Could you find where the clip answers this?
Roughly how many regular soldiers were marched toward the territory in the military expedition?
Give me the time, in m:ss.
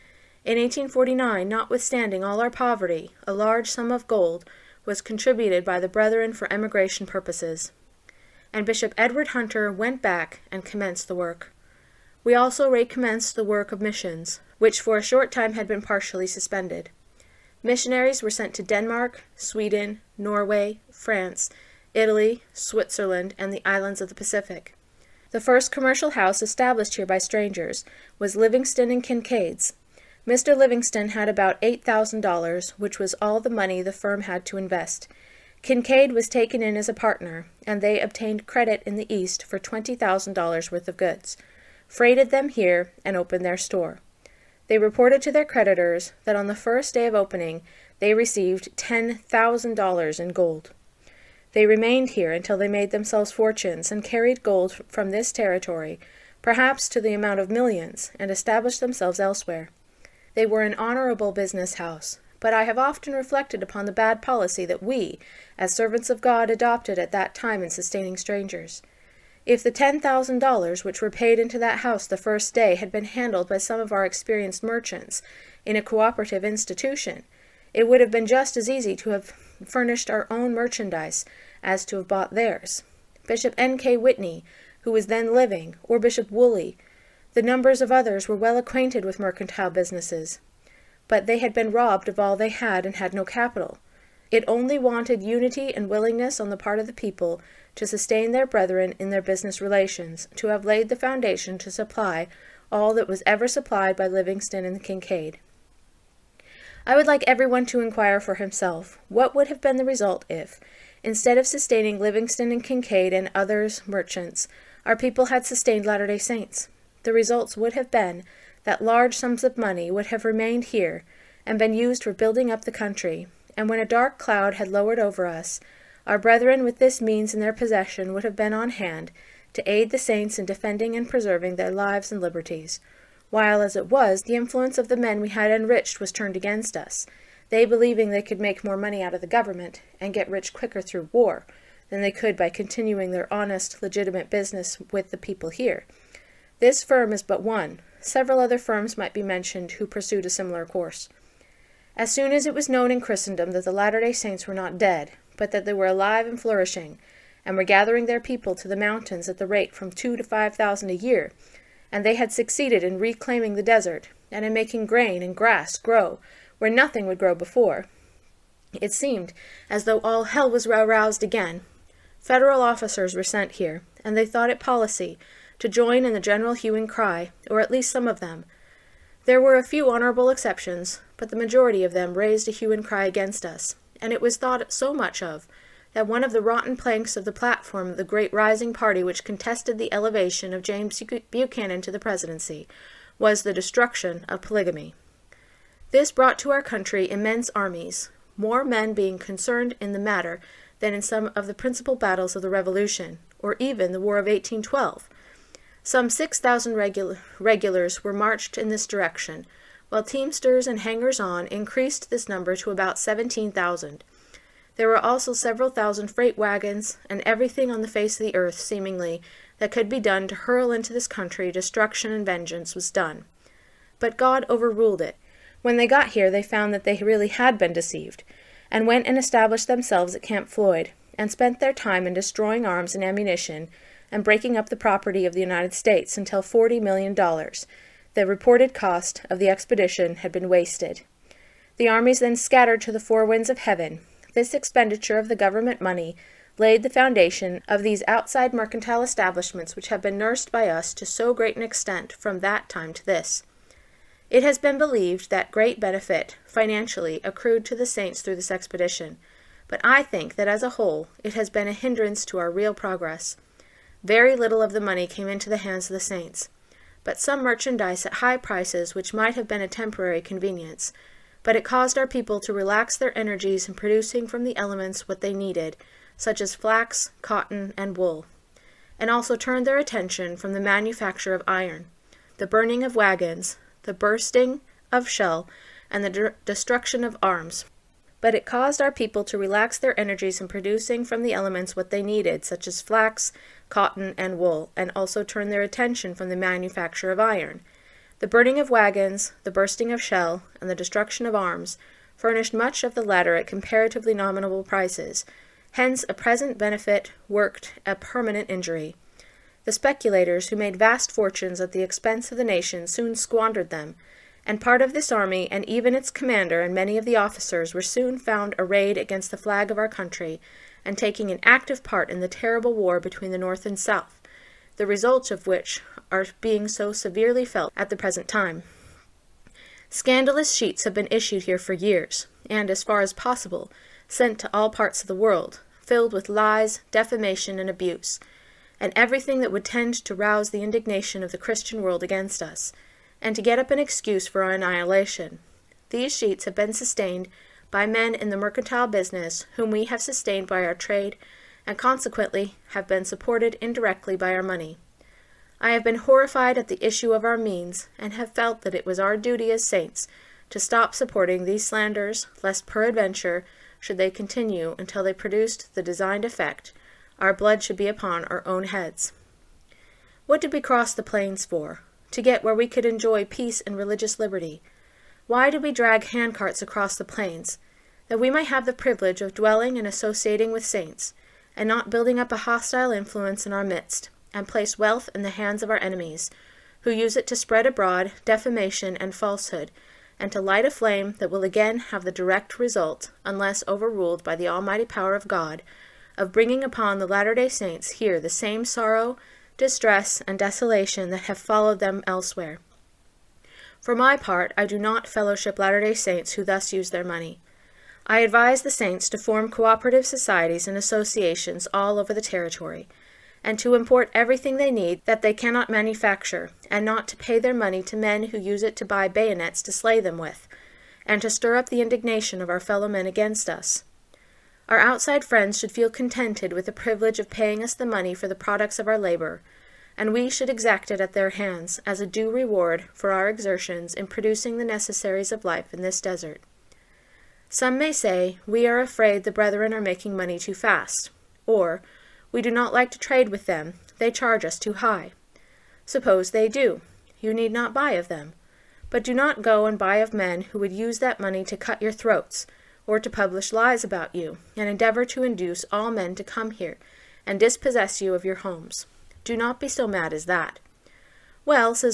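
3:26.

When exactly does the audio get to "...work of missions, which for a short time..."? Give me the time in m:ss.
0:13.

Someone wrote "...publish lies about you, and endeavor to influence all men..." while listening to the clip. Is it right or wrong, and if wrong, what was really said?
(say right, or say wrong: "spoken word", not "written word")
wrong: "induce", not "influence".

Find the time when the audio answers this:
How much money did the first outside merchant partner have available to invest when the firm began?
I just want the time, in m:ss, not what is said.
0:31.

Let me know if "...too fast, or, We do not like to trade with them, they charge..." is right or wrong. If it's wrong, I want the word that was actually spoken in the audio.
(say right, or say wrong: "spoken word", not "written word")
right.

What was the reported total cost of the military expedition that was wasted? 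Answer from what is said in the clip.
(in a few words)
forty million dollars.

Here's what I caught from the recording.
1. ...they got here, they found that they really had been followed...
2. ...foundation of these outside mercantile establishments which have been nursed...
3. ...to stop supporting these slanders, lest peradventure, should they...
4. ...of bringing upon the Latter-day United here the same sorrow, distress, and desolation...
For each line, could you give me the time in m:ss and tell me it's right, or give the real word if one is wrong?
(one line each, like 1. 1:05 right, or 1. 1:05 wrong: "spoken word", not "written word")
1. 3:45 wrong: "deceived", not "followed"
2. 4:06 right
3. 6:00 right
4. 6:36 wrong: "Saints", not "United".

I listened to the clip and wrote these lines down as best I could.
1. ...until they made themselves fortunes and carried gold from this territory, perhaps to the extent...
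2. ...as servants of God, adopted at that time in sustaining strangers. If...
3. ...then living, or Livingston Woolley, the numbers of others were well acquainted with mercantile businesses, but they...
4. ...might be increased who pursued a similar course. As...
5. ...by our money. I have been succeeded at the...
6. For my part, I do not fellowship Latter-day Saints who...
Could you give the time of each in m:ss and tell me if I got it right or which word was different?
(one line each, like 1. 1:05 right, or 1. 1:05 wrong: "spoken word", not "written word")
1. 0:52 wrong: "amount", not "extent"
2. 1:05 right
3. 1:25 wrong: "Bishop", not "Livingston"
4. 2:28 wrong: "mentioned", not "increased"
5. 5:54 wrong: "horrified", not "succeeded"
6. 6:43 right.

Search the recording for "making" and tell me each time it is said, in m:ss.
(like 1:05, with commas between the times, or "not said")
2:44, 7:19.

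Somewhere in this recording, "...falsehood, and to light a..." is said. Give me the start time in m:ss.
6:29.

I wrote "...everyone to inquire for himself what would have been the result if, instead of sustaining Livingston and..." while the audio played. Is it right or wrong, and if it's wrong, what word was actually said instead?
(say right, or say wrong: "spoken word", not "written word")
right.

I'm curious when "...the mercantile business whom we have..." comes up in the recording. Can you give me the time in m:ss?
5:48.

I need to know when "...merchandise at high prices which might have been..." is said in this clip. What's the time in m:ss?
4:27.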